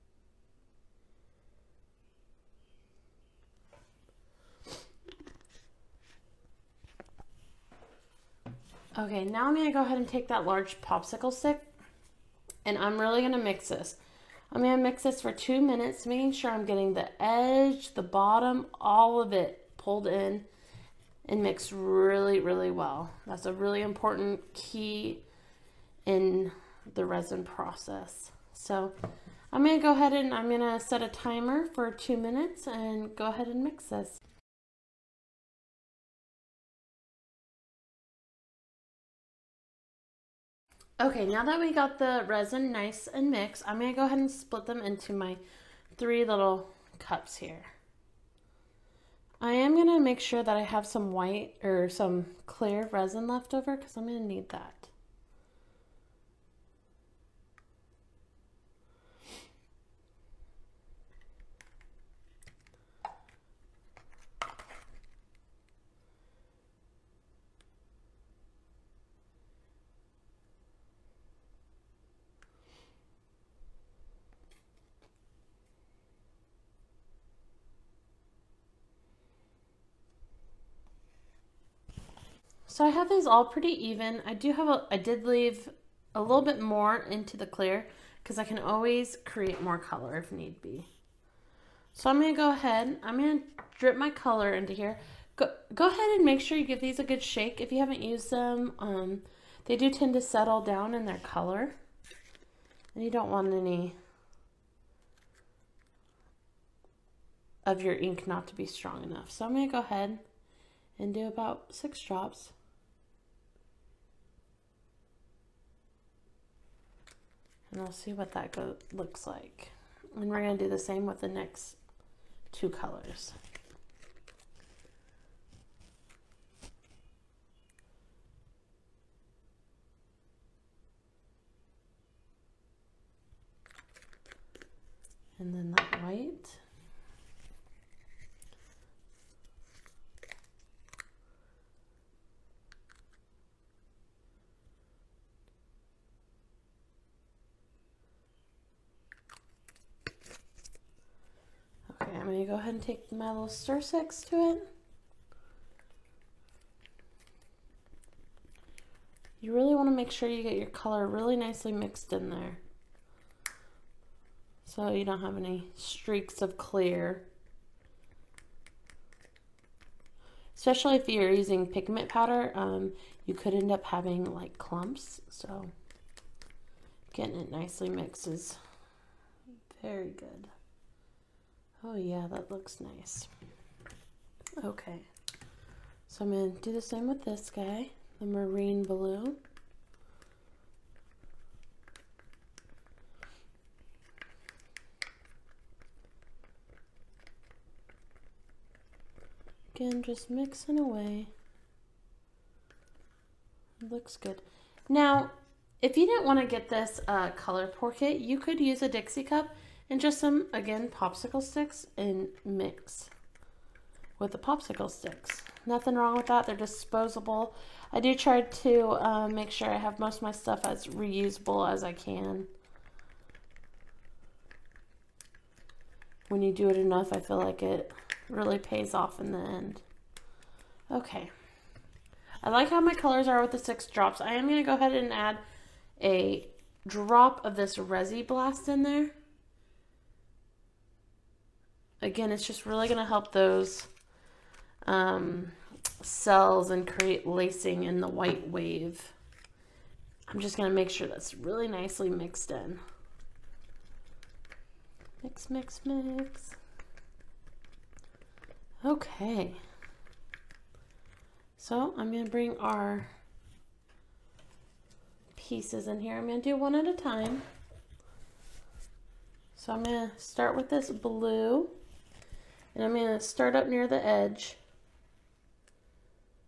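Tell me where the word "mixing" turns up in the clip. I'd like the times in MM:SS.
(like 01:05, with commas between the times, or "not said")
03:20.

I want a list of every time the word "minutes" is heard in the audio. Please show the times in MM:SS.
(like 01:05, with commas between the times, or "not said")
00:15, 00:32.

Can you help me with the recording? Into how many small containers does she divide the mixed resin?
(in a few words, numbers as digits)
3.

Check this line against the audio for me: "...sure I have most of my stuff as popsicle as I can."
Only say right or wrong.
wrong.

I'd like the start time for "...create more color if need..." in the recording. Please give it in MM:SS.
01:29.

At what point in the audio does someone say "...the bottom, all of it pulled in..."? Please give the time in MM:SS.
00:17.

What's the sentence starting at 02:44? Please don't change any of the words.
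So you don't have any streaks of clear.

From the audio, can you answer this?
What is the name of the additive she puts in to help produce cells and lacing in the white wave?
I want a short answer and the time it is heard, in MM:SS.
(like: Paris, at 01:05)
Resi Blast, at 03:57.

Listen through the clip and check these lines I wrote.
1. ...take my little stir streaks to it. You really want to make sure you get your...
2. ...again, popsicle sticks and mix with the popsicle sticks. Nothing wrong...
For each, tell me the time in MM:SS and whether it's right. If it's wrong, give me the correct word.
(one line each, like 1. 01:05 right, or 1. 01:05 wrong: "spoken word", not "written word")
1. 02:32 wrong: "sticks", not "streaks"
2. 03:30 right.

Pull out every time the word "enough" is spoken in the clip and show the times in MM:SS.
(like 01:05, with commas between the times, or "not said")
01:49, 03:46.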